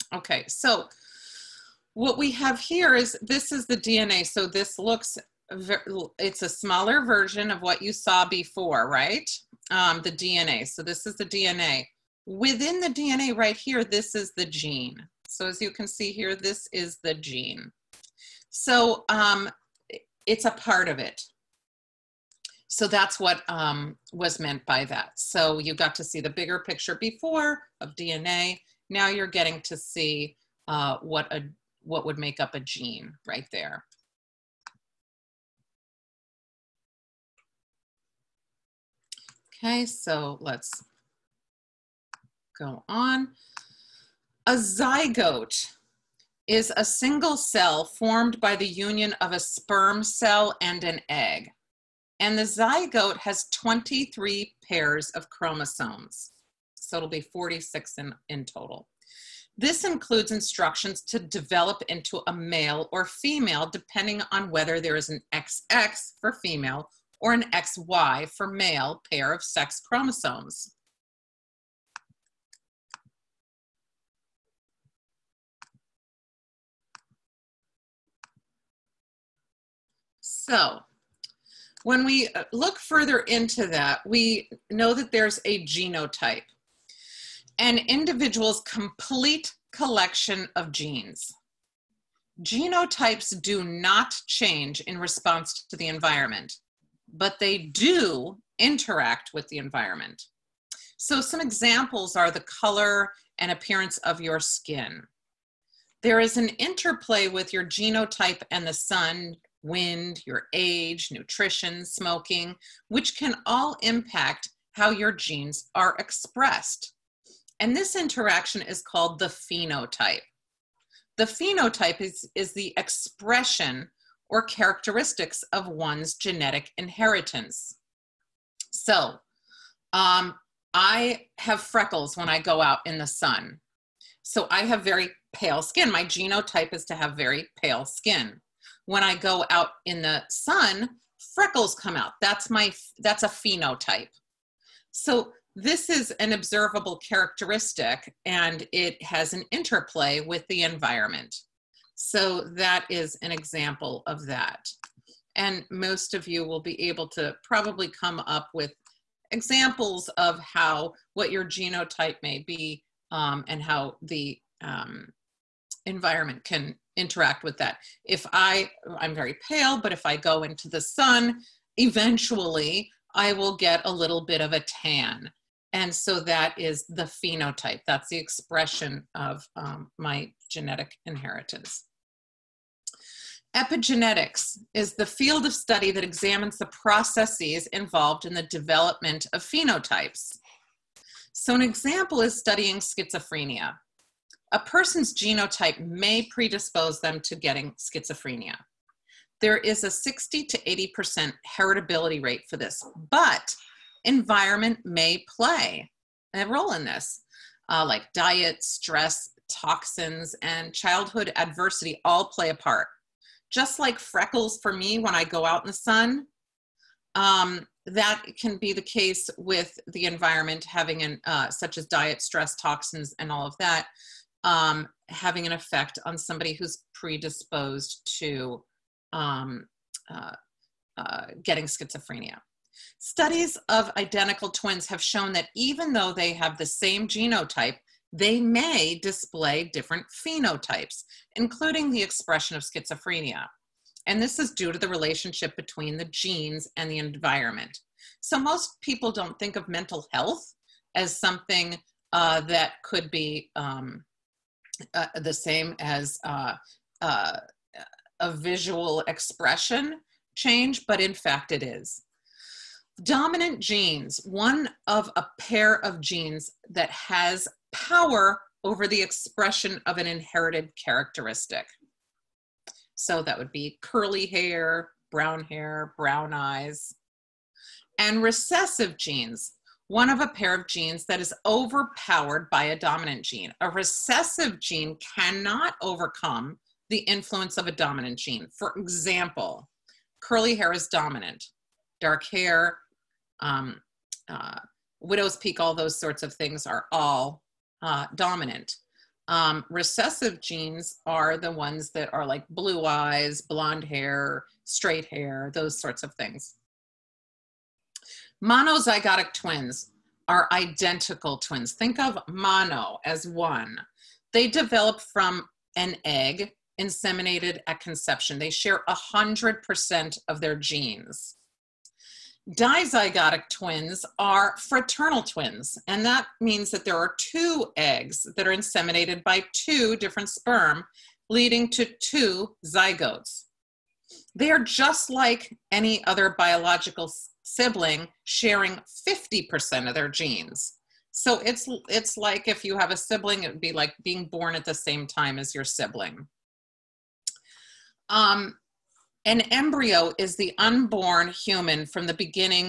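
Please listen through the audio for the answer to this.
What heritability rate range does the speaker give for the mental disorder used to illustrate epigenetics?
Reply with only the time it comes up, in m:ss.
3:19.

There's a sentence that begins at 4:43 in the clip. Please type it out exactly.
A recessive gene cannot overcome the influence of a dominant gene.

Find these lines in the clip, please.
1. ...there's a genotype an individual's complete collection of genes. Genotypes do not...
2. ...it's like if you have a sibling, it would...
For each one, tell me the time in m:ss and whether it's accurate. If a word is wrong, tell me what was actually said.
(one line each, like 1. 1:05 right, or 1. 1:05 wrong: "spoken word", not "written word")
1. 1:25 right
2. 5:41 right.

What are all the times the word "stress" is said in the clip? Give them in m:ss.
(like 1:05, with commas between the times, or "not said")
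3:28, 3:42.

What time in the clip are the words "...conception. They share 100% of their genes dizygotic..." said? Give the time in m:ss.
5:17.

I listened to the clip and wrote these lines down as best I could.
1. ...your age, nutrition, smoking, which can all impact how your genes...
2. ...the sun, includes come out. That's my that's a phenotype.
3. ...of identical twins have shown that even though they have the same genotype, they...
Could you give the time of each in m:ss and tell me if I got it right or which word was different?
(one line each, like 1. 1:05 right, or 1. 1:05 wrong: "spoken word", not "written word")
1. 1:50 right
2. 2:19 wrong: "freckles", not "includes"
3. 3:53 right.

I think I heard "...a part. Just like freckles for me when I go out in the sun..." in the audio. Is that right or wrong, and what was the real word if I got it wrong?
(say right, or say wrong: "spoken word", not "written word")
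right.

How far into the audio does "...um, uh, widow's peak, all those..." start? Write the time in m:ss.
4:53.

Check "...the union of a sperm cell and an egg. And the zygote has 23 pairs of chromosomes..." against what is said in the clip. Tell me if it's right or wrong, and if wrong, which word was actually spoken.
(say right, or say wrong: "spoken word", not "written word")
right.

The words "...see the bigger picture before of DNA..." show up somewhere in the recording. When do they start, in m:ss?
0:26.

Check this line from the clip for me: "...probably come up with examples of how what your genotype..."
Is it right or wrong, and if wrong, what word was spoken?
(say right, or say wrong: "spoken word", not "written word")
right.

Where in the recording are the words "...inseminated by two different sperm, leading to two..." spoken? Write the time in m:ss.
5:28.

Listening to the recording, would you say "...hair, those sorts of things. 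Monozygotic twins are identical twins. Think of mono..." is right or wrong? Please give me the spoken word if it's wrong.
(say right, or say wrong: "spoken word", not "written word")
right.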